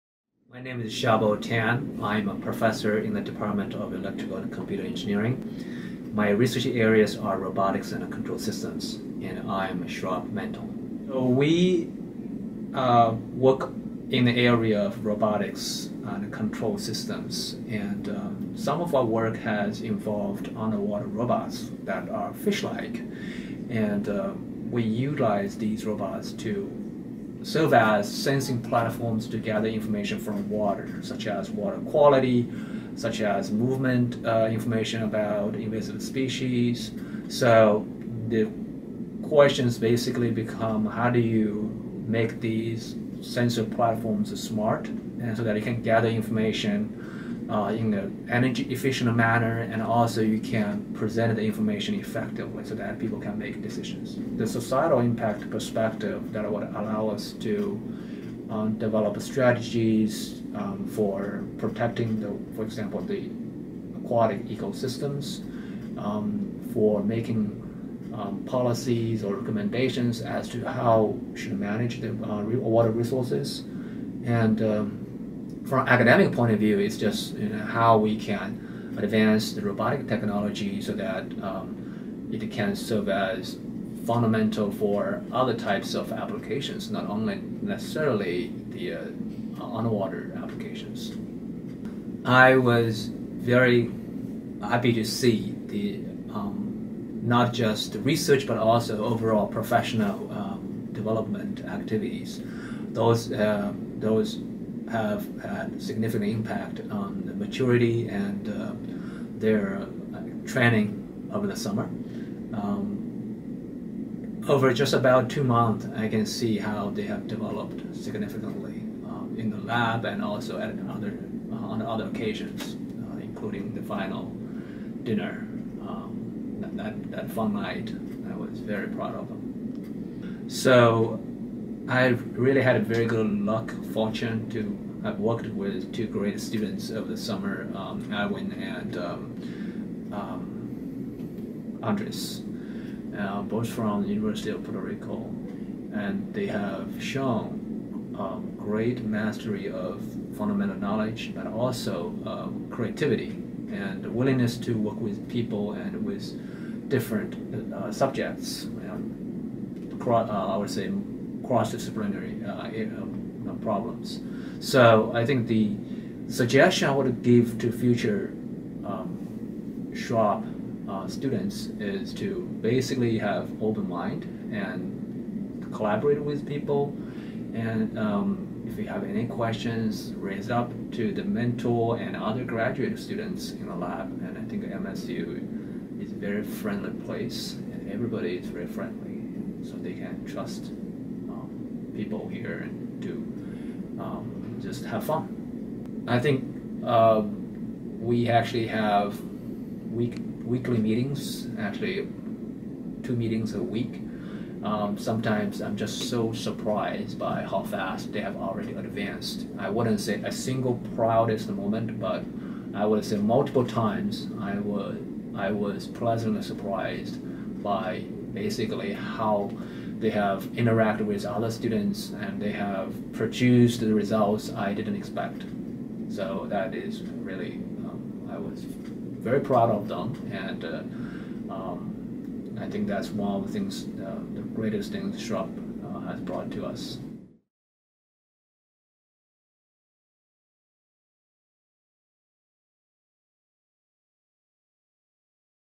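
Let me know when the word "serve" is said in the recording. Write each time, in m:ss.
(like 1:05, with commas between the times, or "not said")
0:27, 1:22.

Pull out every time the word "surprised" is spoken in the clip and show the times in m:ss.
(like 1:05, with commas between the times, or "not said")
3:26, 3:36.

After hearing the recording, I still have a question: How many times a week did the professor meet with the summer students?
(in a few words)
2 meetings.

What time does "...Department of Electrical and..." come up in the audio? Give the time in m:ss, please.
0:03.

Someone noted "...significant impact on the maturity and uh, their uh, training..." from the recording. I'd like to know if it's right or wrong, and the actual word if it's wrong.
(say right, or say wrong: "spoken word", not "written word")
right.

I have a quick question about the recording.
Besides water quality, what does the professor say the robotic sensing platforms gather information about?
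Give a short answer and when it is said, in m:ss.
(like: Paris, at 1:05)
Invasive species, at 0:35.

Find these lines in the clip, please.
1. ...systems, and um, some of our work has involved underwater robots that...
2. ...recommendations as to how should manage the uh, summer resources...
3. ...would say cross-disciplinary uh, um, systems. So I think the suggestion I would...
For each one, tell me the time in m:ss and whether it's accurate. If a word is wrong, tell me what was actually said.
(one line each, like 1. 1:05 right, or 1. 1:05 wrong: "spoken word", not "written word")
1. 0:16 right
2. 1:09 wrong: "water", not "summer"
3. 2:40 wrong: "problems", not "systems".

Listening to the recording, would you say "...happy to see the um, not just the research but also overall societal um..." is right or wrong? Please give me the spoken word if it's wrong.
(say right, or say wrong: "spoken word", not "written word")
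wrong: "professional", not "societal".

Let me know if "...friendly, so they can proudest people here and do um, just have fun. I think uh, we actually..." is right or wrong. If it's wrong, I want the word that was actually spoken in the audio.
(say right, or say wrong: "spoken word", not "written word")
wrong: "trust", not "proudest".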